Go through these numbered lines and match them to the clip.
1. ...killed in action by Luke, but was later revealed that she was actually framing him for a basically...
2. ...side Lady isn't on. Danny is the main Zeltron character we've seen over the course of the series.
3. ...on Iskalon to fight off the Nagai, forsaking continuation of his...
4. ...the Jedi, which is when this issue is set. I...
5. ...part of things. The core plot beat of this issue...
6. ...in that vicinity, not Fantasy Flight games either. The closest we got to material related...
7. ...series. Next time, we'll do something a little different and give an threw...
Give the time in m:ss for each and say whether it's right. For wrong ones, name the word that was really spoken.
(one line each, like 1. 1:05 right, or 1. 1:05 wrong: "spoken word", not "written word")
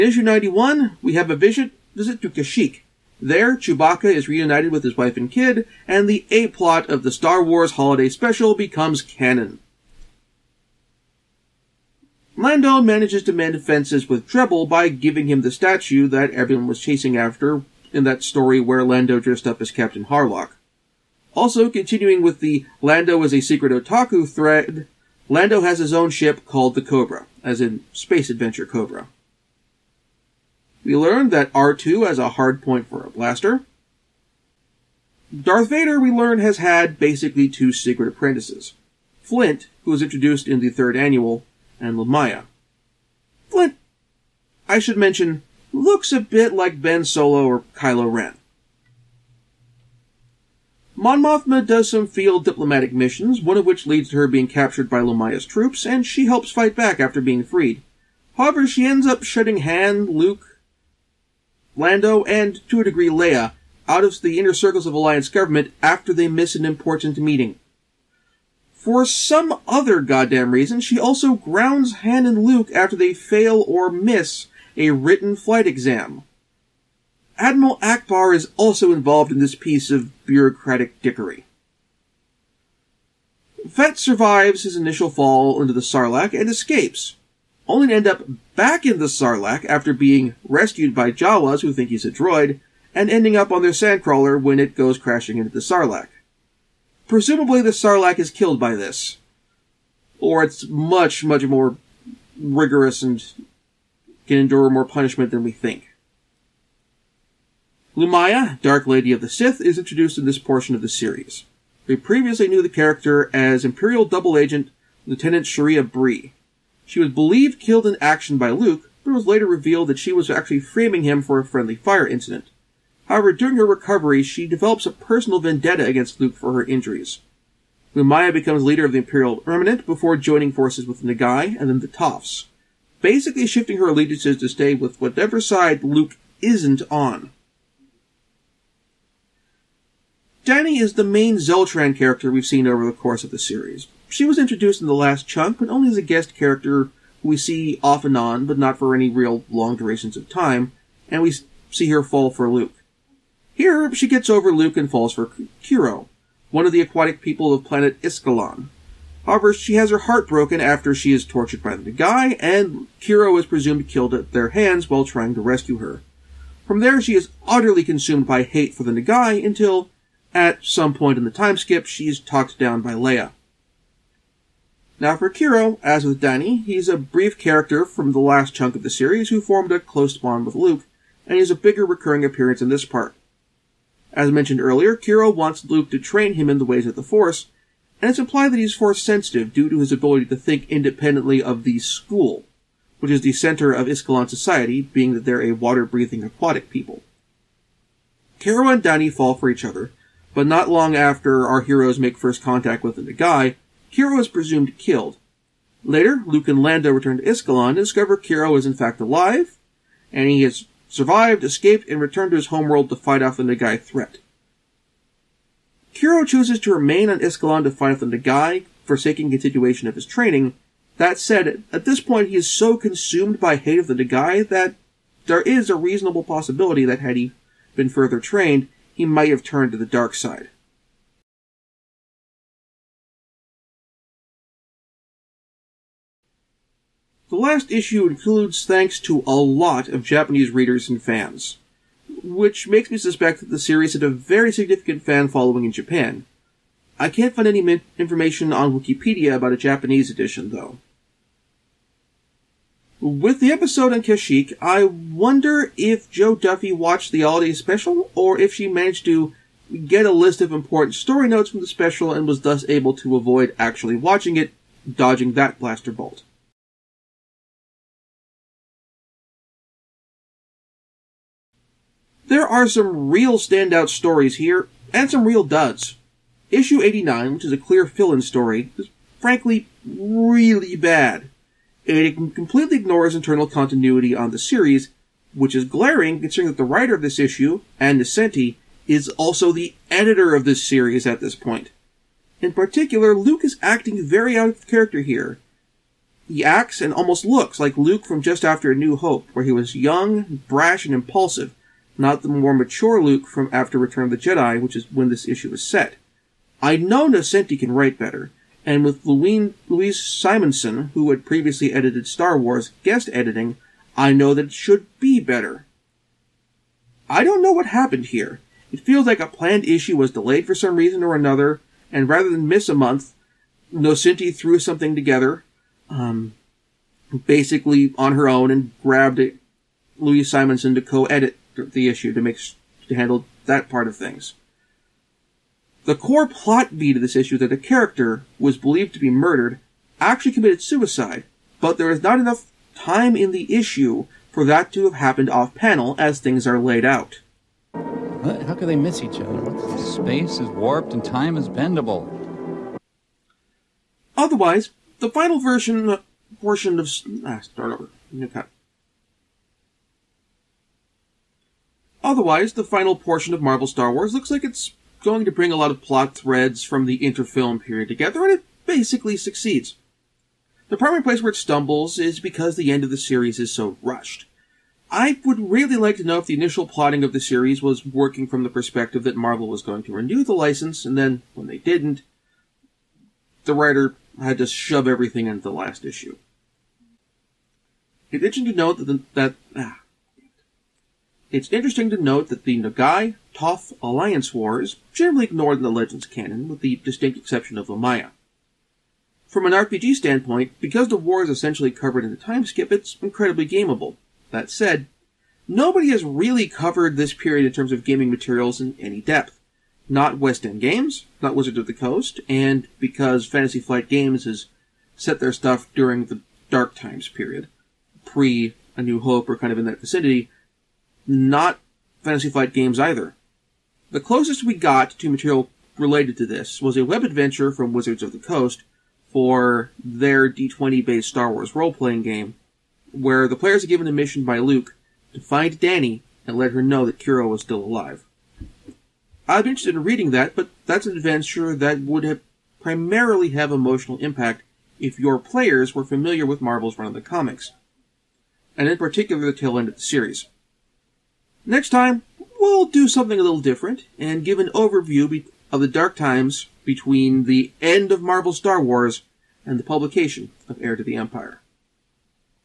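1. 1:57 wrong: "friendly", not "basically"
2. 2:15 wrong: "Luke", not "Lady"
3. 3:37 right
4. 5:04 right
5. 5:33 right
6. 6:59 right
7. 7:29 wrong: "overview", not "threw".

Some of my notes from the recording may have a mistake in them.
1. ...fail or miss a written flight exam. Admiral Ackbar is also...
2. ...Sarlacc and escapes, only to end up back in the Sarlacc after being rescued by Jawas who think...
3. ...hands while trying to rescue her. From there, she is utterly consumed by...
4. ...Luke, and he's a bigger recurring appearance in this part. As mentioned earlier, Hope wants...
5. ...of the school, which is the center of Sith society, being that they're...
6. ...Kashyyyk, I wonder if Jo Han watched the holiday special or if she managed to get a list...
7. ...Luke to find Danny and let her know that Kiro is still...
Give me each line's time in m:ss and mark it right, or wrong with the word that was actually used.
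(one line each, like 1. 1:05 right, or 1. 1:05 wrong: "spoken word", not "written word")
1. 1:13 right
2. 1:25 right
3. 2:44 right
4. 3:00 wrong: "Kiro", not "Hope"
5. 3:11 wrong: "Iskalon", not "Sith"
6. 4:14 wrong: "Duffy", not "Han"
7. 7:14 right.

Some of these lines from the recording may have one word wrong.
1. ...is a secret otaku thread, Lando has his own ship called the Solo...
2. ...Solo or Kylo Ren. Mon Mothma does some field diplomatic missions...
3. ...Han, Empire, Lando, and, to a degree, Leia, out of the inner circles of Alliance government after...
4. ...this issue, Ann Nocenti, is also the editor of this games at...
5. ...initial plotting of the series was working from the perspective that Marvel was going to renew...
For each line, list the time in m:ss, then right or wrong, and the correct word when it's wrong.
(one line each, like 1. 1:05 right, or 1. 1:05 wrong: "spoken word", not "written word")
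1. 0:23 wrong: "Cobra", not "Solo"
2. 0:47 right
3. 0:59 wrong: "Luke", not "Empire"
4. 4:47 wrong: "series", not "games"
5. 6:16 right.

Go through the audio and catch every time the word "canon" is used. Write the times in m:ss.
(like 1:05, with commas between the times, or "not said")
0:09, 6:36.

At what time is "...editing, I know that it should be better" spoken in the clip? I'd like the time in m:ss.
5:13.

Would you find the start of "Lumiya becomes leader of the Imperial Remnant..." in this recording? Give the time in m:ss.
2:07.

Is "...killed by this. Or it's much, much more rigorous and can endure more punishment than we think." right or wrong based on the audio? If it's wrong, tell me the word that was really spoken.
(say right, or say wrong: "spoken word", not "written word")
right.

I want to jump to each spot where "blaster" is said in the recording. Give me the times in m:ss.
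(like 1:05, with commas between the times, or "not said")
0:33, 4:25.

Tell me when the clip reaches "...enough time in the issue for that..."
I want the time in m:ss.
5:42.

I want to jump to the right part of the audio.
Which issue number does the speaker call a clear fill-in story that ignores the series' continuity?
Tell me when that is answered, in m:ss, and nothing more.
4:36.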